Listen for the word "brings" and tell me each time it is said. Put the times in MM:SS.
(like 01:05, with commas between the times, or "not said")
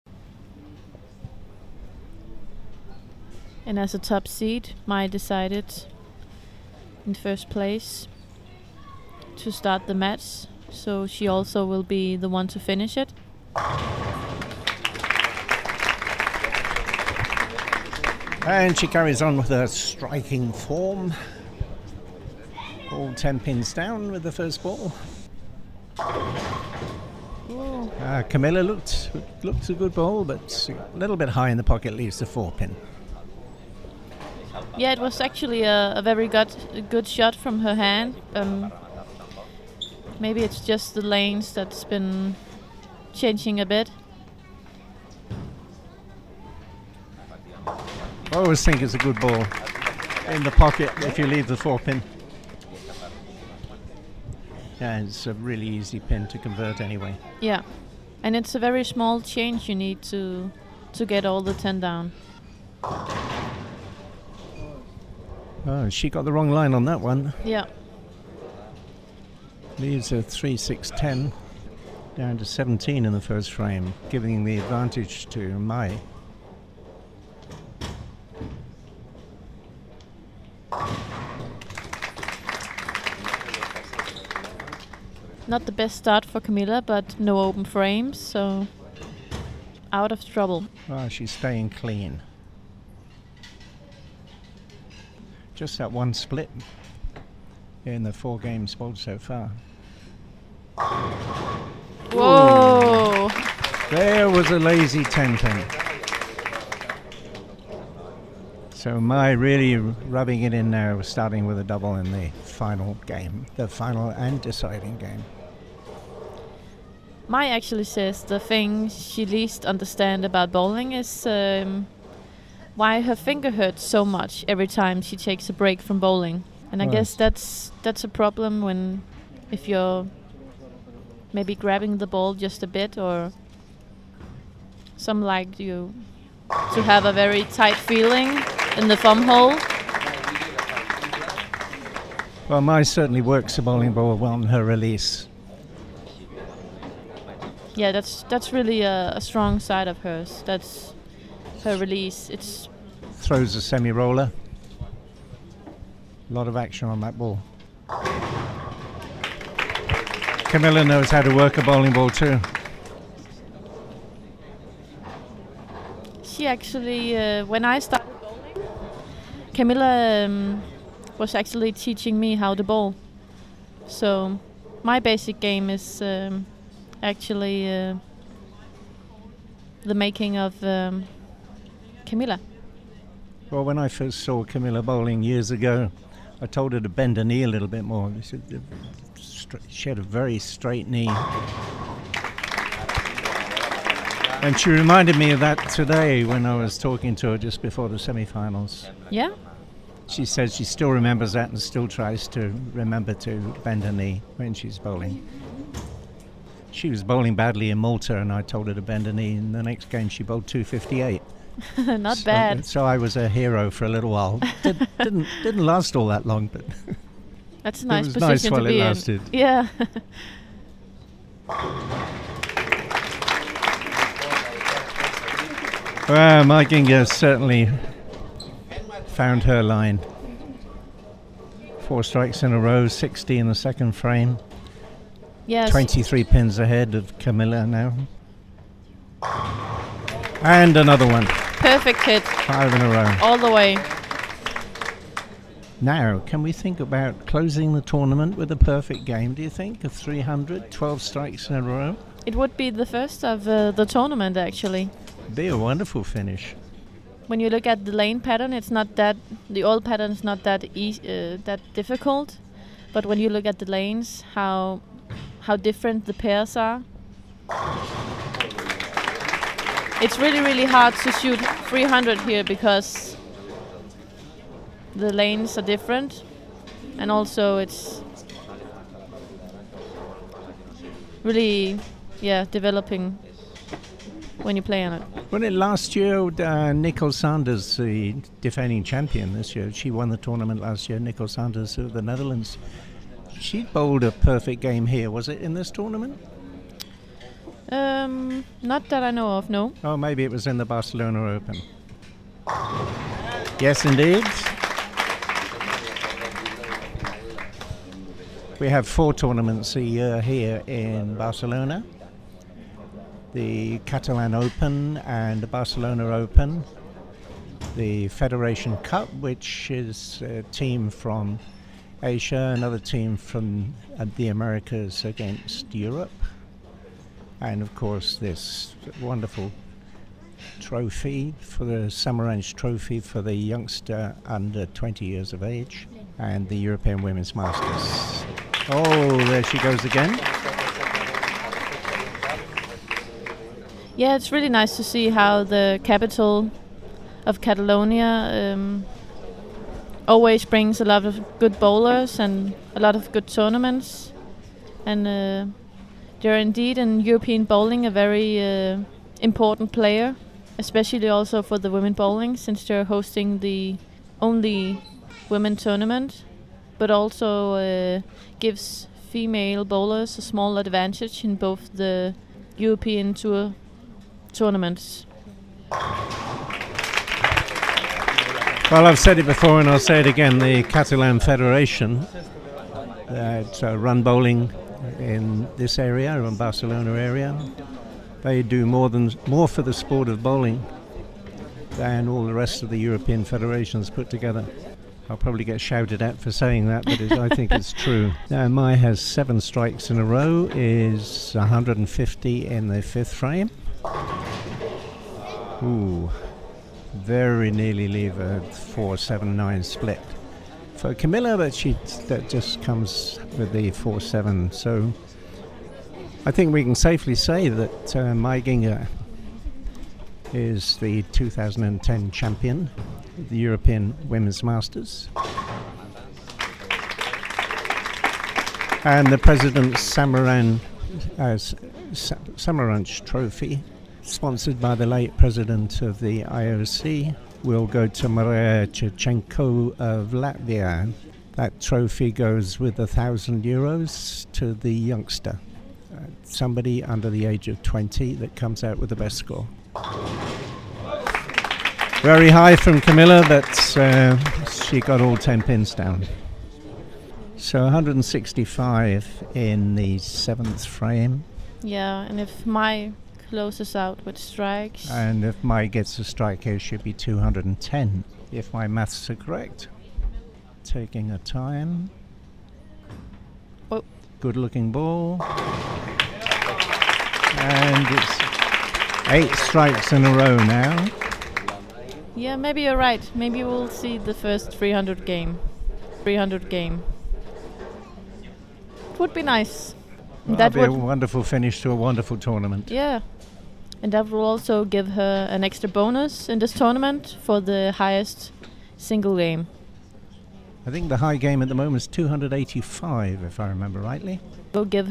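05:50.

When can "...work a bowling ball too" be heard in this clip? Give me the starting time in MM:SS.
02:41.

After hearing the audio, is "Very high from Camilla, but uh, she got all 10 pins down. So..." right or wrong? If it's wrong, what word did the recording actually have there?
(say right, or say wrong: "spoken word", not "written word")
right.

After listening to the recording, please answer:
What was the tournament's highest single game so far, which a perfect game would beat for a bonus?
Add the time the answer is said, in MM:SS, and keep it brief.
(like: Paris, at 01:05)
285, at 08:21.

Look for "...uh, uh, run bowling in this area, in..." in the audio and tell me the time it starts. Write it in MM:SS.
06:23.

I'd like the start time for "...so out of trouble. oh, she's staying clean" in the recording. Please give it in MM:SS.
01:28.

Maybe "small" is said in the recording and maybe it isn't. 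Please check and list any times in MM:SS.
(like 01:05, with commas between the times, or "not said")
00:58, 06:10.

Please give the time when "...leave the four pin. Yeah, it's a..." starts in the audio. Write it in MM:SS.
00:51.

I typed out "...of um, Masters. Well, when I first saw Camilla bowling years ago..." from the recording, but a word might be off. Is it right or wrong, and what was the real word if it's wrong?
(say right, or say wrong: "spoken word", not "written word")
wrong: "Camilla", not "Masters".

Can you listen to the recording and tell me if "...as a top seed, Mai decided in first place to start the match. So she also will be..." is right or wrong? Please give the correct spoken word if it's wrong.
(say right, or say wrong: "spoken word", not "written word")
right.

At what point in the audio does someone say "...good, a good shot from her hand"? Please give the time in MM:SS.
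00:36.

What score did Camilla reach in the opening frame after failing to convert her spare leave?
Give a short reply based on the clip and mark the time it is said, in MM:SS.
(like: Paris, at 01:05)
17, at 01:12.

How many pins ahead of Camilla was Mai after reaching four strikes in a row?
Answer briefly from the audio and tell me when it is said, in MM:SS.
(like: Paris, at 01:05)
23, at 03:55.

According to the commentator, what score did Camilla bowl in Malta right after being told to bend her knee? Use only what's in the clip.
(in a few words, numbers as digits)
258.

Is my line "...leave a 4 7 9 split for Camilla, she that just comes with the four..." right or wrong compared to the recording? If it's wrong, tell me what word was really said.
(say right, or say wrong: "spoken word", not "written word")
right.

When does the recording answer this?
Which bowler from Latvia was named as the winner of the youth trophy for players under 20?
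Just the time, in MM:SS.
07:18.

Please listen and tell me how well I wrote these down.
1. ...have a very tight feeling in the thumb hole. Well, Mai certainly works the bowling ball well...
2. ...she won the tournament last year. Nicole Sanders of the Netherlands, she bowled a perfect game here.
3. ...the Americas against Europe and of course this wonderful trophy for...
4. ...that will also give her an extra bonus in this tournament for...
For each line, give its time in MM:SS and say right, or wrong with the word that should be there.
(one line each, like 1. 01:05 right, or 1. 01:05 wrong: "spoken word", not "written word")
1. 02:16 right
2. 04:49 right
3. 05:24 right
4. 08:13 right.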